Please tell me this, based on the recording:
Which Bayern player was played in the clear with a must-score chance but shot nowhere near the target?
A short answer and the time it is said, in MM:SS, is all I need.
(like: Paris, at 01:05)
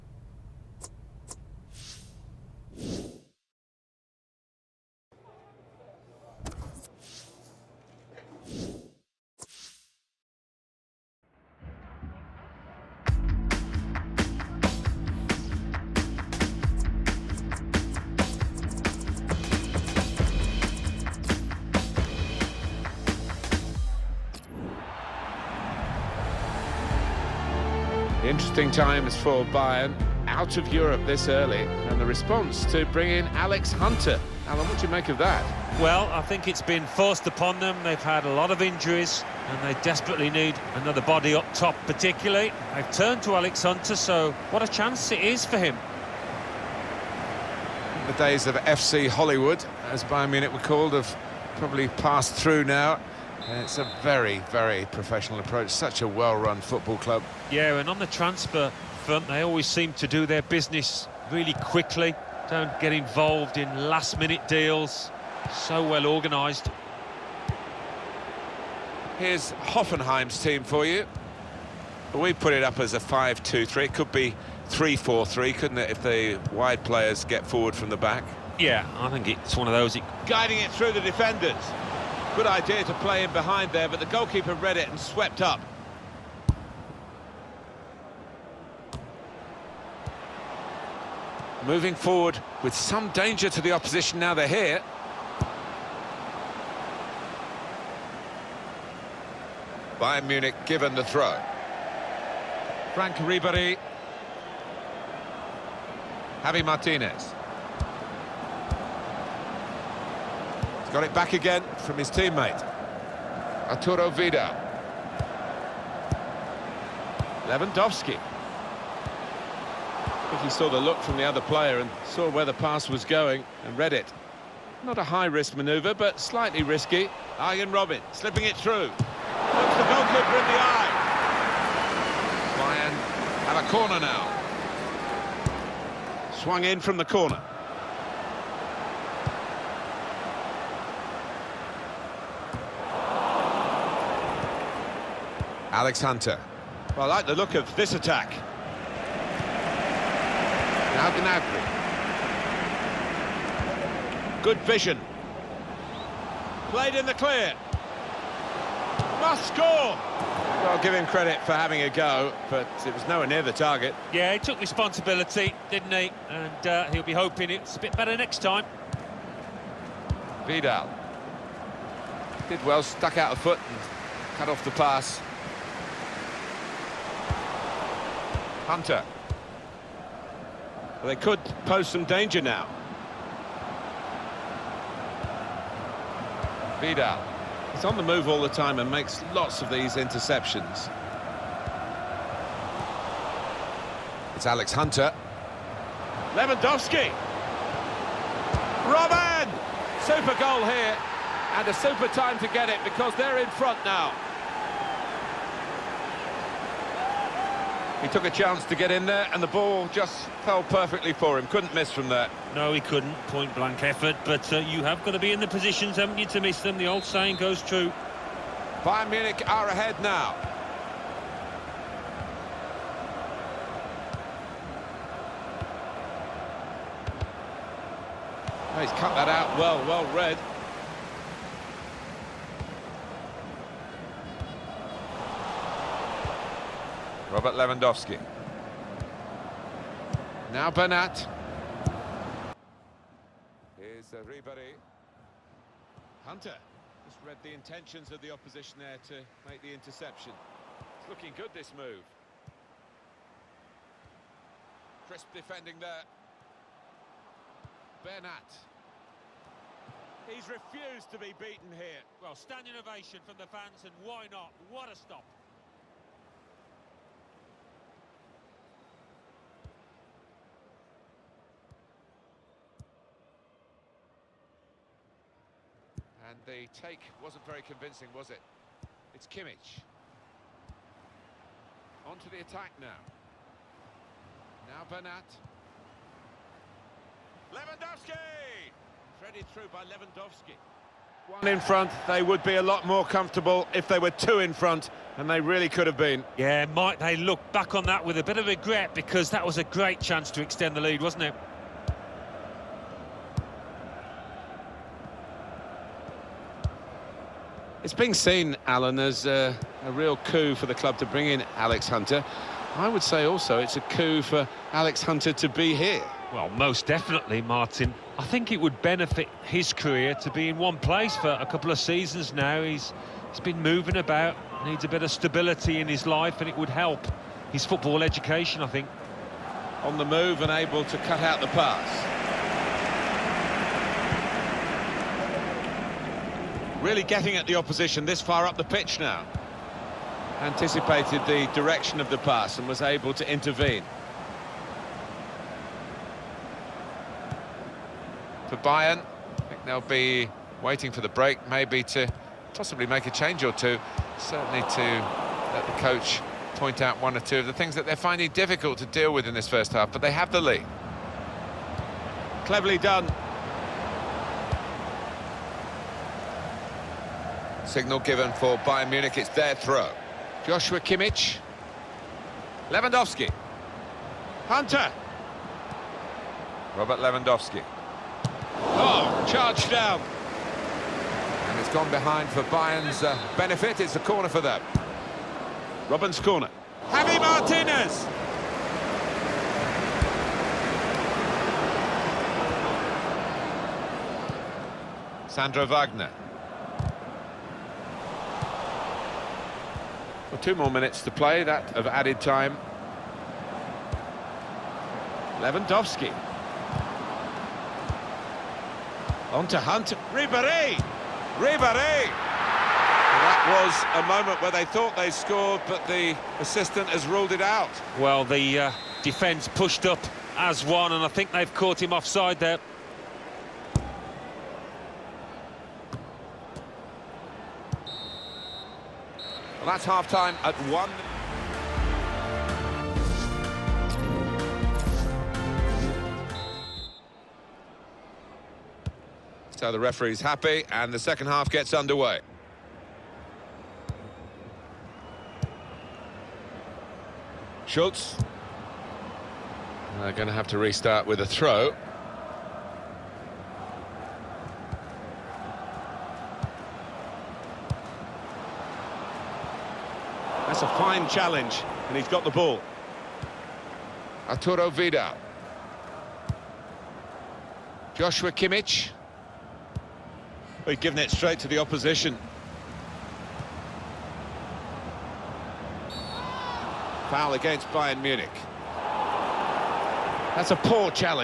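Gnabry, at 02:31.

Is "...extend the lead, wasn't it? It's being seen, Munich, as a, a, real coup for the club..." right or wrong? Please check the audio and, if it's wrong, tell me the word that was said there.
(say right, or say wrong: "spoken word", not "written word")
wrong: "Alan", not "Munich".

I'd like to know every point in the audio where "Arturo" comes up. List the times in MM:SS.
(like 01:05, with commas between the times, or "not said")
01:53, 07:44.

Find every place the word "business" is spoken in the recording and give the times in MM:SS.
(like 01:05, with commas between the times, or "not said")
01:00.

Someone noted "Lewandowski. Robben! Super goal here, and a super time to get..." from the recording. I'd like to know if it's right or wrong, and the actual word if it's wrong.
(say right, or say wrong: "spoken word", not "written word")
right.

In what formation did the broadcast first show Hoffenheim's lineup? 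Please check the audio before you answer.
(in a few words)
5-2-3.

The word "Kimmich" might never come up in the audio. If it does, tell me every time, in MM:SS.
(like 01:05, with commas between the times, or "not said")
04:39, 06:10, 07:48.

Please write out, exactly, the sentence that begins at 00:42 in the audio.
They've turned to Alex Hunter, so what a chance it is for him.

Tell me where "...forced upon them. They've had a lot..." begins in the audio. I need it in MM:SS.
00:36.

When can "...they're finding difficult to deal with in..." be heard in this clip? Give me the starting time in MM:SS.
05:57.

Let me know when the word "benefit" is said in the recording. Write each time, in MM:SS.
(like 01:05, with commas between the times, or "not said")
05:18, 06:23.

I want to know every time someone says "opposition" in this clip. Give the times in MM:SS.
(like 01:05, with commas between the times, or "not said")
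01:33, 04:08, 05:37, 07:51.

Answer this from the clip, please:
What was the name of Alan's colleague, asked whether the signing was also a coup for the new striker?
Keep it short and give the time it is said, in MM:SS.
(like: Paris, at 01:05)
Martin, at 05:17.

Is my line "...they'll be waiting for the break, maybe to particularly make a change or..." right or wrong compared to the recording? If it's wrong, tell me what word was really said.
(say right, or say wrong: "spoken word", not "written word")
wrong: "possibly", not "particularly".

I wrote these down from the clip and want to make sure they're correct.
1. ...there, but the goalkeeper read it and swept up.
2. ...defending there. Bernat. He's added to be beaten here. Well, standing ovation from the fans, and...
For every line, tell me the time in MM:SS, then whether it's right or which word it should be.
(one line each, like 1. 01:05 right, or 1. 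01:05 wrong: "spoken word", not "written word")
1. 01:23 right
2. 04:15 wrong: "refused", not "added".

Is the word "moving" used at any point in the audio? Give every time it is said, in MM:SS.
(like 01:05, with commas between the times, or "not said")
01:31, 05:23.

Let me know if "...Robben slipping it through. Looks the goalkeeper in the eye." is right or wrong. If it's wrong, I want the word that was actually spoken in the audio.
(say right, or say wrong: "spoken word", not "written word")
right.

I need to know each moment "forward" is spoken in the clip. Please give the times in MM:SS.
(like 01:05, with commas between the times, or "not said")
01:17, 01:31.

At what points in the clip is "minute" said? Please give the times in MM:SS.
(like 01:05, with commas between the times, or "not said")
01:03, 06:40.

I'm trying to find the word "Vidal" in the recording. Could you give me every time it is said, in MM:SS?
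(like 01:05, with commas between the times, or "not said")
01:54, 02:50, 03:06, 07:44.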